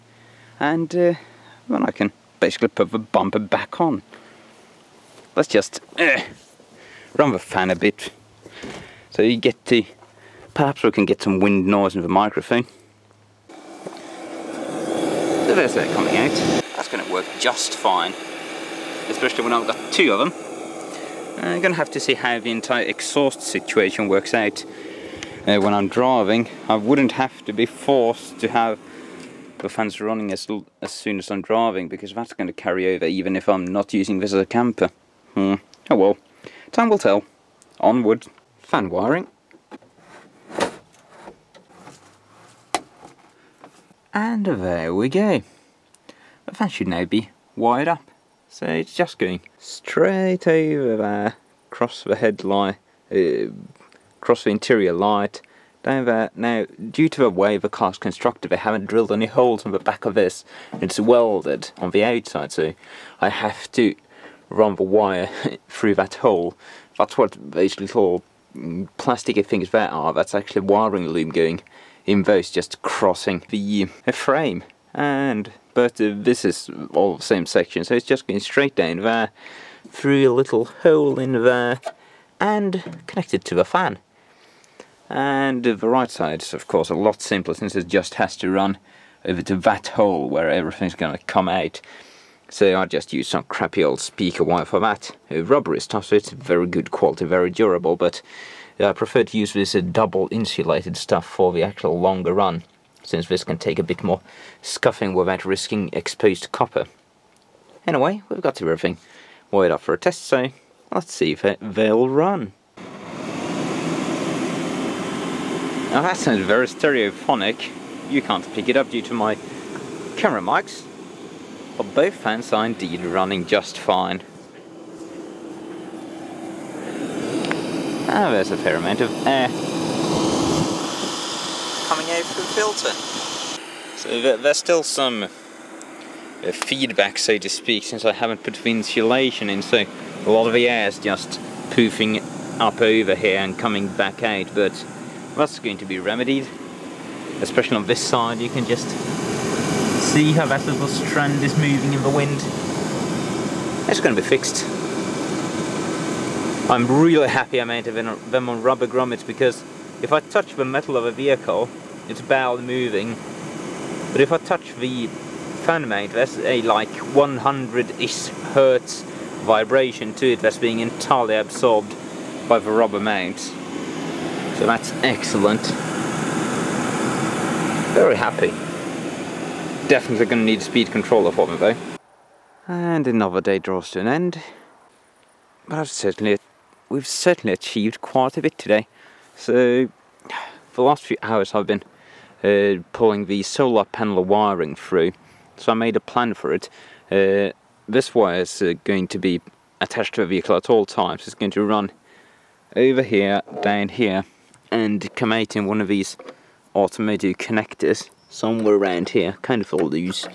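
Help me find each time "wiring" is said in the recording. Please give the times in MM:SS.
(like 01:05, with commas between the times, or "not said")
00:38, 01:10, 03:14.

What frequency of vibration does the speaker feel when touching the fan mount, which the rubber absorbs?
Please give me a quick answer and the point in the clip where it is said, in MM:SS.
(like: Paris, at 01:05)
100-ish hertz, at 02:46.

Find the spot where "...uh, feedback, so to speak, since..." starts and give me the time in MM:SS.
02:15.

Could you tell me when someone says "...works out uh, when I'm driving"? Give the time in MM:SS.
00:24.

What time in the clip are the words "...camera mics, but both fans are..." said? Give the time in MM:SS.
02:00.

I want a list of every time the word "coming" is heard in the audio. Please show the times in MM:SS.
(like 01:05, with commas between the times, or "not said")
00:15, 02:11, 02:23.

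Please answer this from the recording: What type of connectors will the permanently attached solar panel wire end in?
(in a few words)
automotive connectors.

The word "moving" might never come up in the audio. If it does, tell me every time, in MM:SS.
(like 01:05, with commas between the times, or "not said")
02:31, 02:42.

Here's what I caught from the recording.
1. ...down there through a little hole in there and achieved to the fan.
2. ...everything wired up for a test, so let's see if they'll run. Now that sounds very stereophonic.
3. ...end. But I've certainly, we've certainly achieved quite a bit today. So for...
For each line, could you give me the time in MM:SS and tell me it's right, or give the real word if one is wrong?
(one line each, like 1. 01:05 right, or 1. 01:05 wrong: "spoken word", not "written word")
1. 01:18 wrong: "connected", not "achieved"
2. 01:48 right
3. 03:04 right.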